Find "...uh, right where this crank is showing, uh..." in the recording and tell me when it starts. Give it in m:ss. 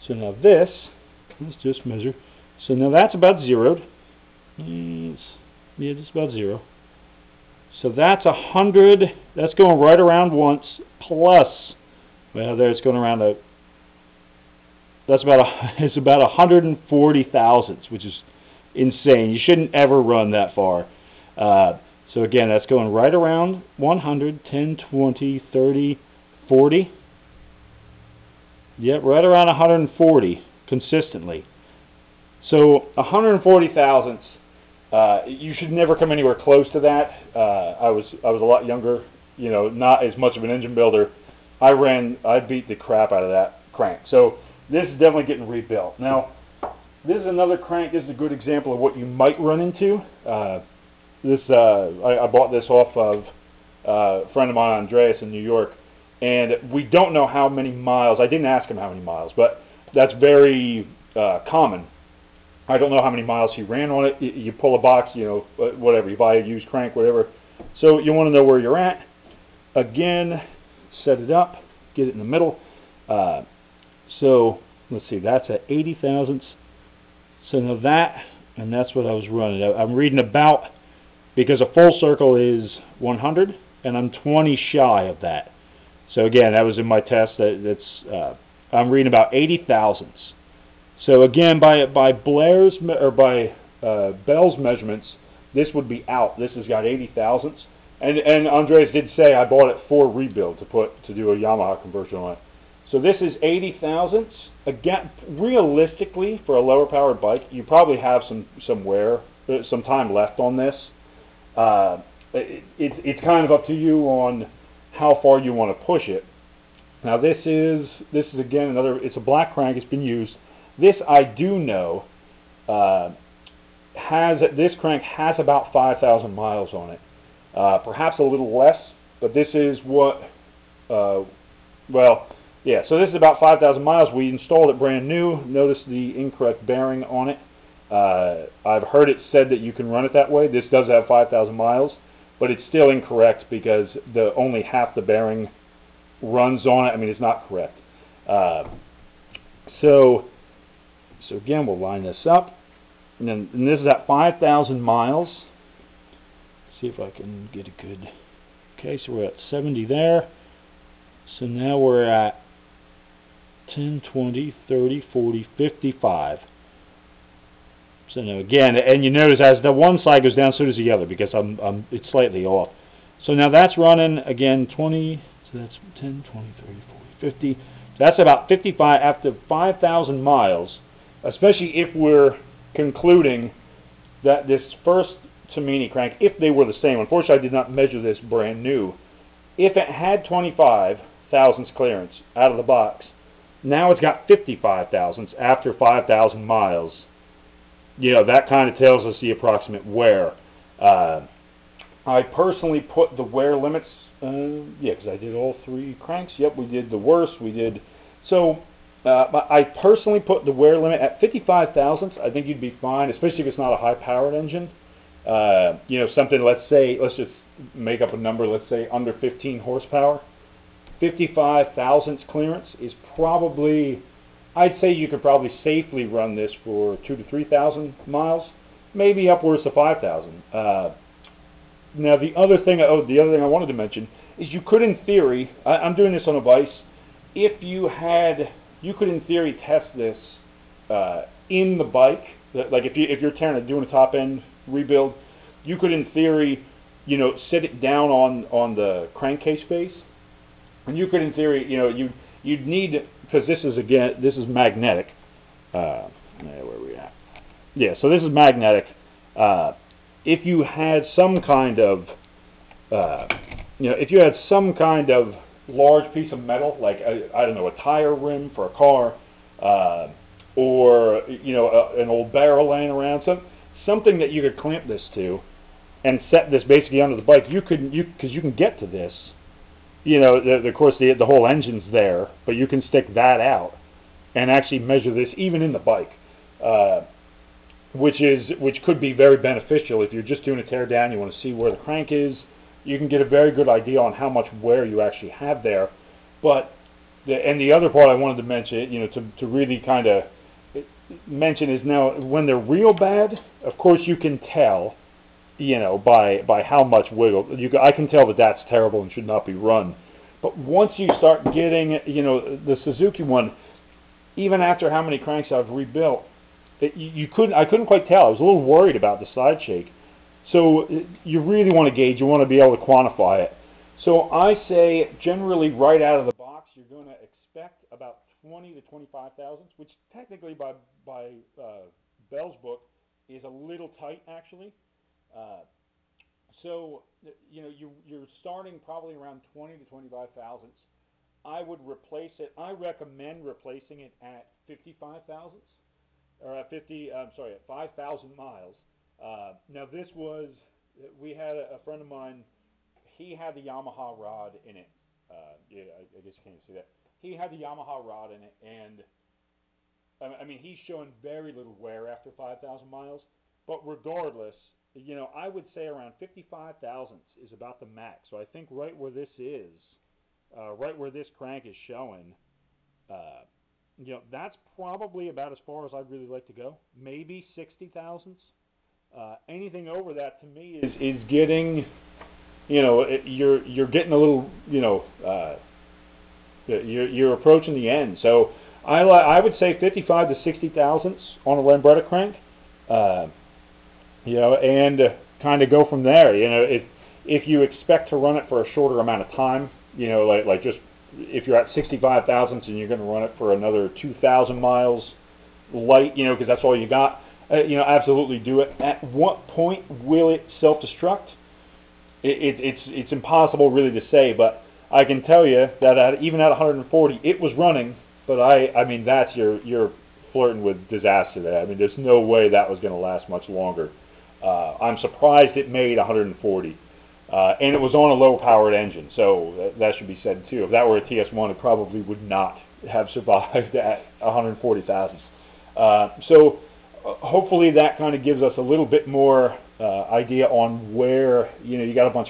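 6:10.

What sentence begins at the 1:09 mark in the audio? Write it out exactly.
Again, set it up, get it in the middle.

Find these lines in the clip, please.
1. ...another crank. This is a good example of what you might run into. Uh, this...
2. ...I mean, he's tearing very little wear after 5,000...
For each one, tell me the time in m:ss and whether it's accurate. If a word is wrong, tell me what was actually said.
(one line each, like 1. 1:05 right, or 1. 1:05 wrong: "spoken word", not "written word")
1. 0:47 right
2. 6:00 wrong: "showing", not "tearing".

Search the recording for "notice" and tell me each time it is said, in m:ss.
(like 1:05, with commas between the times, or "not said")
2:15, 2:49.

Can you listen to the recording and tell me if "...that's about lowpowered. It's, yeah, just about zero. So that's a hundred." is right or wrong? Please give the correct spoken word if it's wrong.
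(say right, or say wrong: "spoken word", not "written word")
wrong: "zeroed", not "lowpowered".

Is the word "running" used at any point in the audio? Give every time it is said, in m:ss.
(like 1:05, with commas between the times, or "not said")
1:19, 2:53, 6:57.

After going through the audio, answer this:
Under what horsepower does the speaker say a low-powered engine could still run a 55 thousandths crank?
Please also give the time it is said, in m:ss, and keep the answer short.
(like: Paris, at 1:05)
15 horsepower, at 3:39.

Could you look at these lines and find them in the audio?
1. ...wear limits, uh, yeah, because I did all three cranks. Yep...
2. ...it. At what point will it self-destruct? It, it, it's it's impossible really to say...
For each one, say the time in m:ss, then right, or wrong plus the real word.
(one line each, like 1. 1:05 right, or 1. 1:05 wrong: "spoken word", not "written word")
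1. 3:23 right
2. 6:48 right.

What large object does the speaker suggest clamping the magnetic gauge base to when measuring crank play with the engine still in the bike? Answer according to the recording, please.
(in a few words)
a tire rim.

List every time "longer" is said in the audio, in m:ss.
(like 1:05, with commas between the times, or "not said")
7:03.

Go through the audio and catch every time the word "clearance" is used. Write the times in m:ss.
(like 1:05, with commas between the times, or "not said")
3:11, 3:42.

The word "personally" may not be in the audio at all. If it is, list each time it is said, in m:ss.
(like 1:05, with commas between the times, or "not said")
3:22, 3:29.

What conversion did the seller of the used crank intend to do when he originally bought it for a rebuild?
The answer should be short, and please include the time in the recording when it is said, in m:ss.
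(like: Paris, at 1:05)
Yamaha conversion, at 1:41.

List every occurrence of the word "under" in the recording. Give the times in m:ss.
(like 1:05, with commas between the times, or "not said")
3:38, 4:36.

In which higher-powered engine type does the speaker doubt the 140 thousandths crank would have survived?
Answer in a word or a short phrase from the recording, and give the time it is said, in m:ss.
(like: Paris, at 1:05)
TS1, at 7:11.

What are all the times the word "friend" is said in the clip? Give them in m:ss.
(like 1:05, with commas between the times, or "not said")
0:54, 5:51.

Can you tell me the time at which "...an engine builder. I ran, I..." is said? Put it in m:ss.
0:40.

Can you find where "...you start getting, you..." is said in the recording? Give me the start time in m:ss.
5:10.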